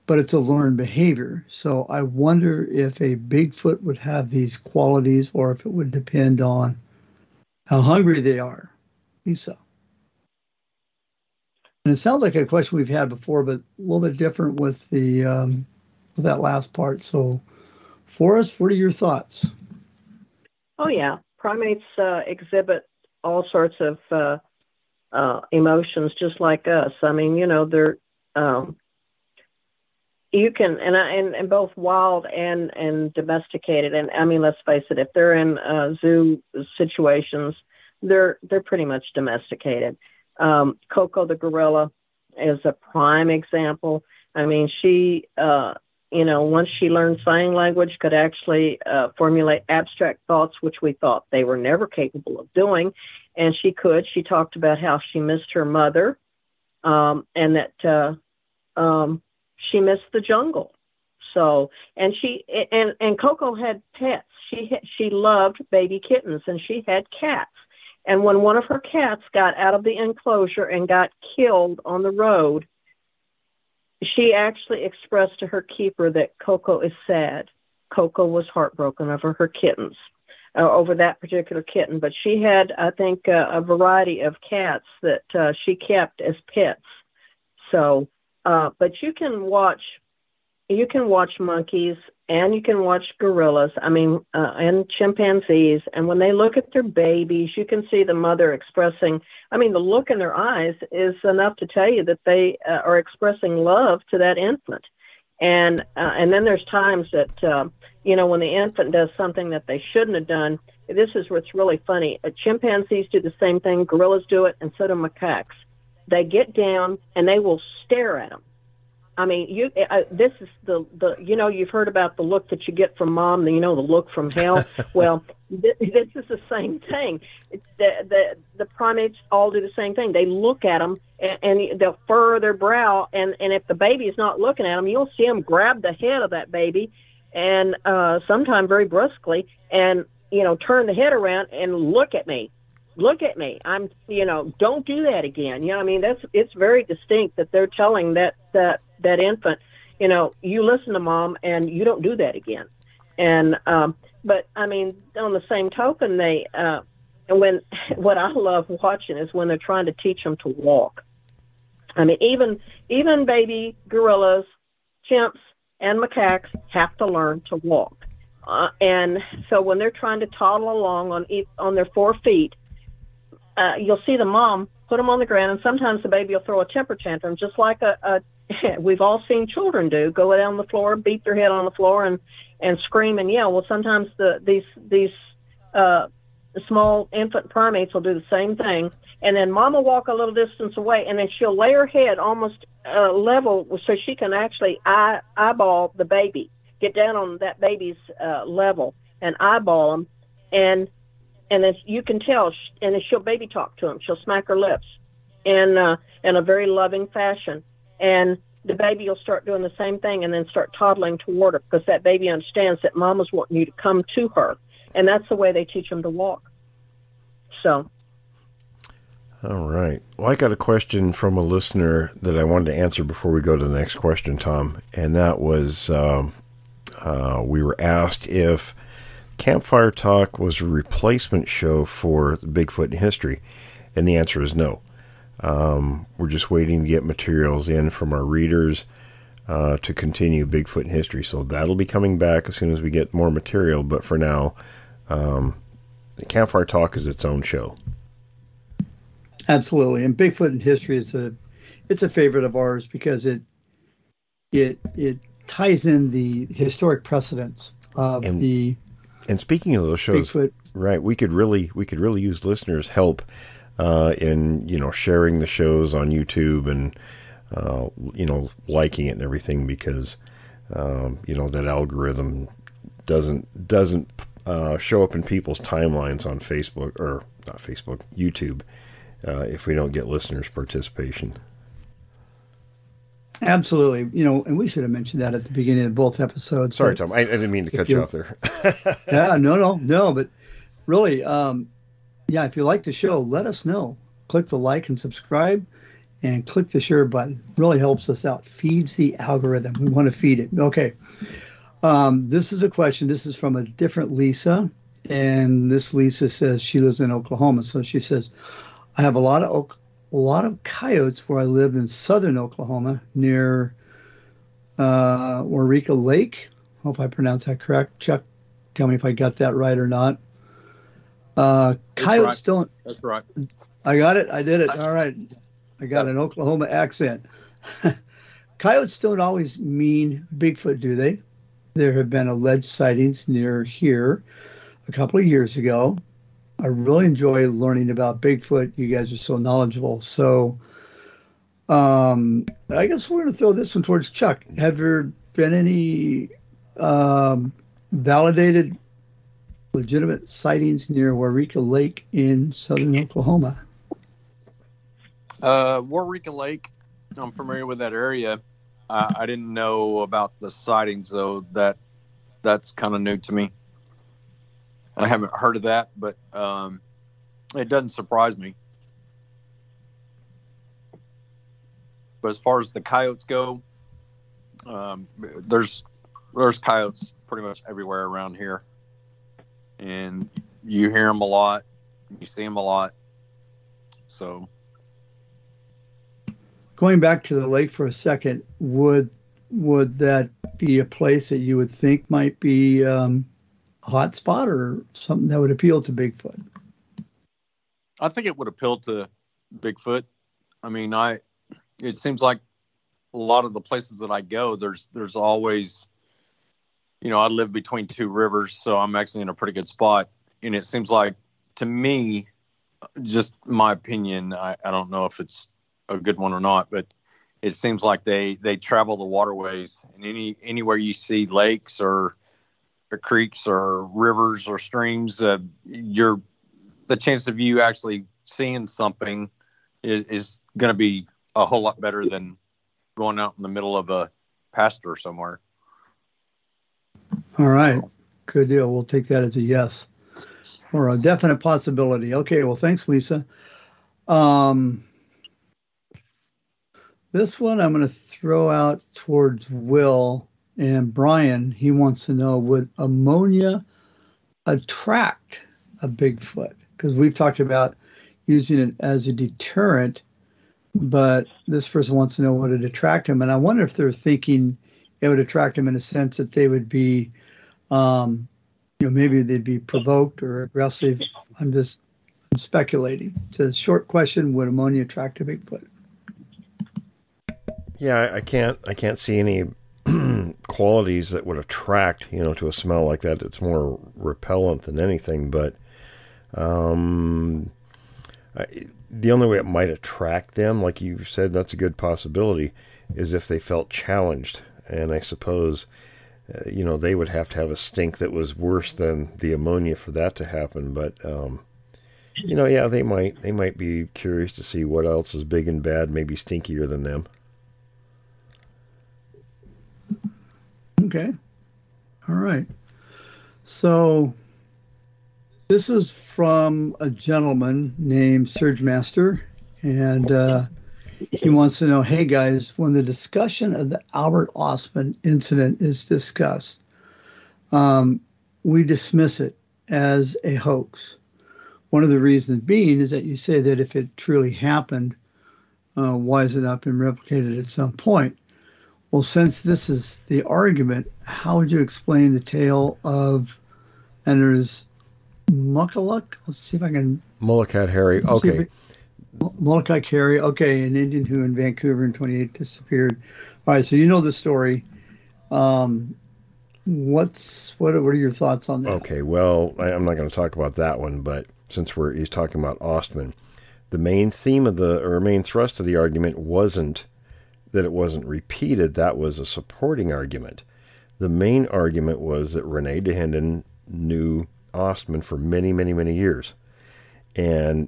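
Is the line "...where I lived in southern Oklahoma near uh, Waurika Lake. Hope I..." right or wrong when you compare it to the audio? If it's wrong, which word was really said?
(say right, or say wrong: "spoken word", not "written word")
right.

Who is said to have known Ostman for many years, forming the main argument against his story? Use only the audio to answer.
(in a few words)
Rene Dahinden.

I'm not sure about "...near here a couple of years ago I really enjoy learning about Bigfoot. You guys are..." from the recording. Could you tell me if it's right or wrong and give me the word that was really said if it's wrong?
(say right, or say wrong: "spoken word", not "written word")
right.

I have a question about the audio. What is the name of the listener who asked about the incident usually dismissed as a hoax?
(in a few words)
Serge Master.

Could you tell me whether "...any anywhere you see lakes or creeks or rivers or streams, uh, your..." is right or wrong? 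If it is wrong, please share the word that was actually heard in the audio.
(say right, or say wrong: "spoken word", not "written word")
right.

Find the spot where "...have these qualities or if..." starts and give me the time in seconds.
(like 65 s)
3 s.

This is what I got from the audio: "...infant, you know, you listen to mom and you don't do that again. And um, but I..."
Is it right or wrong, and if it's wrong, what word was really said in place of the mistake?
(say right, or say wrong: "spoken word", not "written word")
right.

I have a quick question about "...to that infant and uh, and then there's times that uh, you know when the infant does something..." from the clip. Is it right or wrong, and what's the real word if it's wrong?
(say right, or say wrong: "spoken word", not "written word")
right.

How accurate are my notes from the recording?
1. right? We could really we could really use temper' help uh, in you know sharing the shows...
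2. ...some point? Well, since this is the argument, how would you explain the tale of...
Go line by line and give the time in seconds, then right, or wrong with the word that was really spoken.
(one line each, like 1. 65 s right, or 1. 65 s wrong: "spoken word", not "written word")
1. 260 s wrong: "listeners", not "temper"
2. 537 s right.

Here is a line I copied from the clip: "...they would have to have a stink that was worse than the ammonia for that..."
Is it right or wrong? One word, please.
right.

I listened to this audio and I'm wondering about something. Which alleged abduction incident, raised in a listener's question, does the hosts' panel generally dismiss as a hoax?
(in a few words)
Albert Ostman incident.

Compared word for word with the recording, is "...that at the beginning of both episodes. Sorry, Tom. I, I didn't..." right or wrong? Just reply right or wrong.
right.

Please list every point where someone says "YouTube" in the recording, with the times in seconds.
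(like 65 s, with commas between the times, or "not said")
266 s, 278 s.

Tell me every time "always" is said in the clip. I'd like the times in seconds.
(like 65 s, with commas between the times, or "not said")
329 s, 405 s.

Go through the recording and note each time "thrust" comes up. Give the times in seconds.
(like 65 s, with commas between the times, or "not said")
565 s.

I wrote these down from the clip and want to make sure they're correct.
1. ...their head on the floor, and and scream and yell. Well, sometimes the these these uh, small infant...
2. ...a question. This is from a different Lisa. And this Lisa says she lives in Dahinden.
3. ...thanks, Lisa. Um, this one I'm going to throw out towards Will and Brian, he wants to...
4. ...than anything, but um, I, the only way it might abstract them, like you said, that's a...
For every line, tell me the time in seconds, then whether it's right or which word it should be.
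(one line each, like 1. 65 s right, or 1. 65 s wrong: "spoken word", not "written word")
1. 181 s right
2. 302 s wrong: "Oklahoma", not "Dahinden"
3. 442 s right
4. 484 s wrong: "attract", not "abstract".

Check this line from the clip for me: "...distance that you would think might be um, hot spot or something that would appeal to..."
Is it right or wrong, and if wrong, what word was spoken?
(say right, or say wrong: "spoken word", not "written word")
wrong: "place", not "distance".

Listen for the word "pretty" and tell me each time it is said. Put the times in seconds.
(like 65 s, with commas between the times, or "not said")
38 s, 377 s, 409 s.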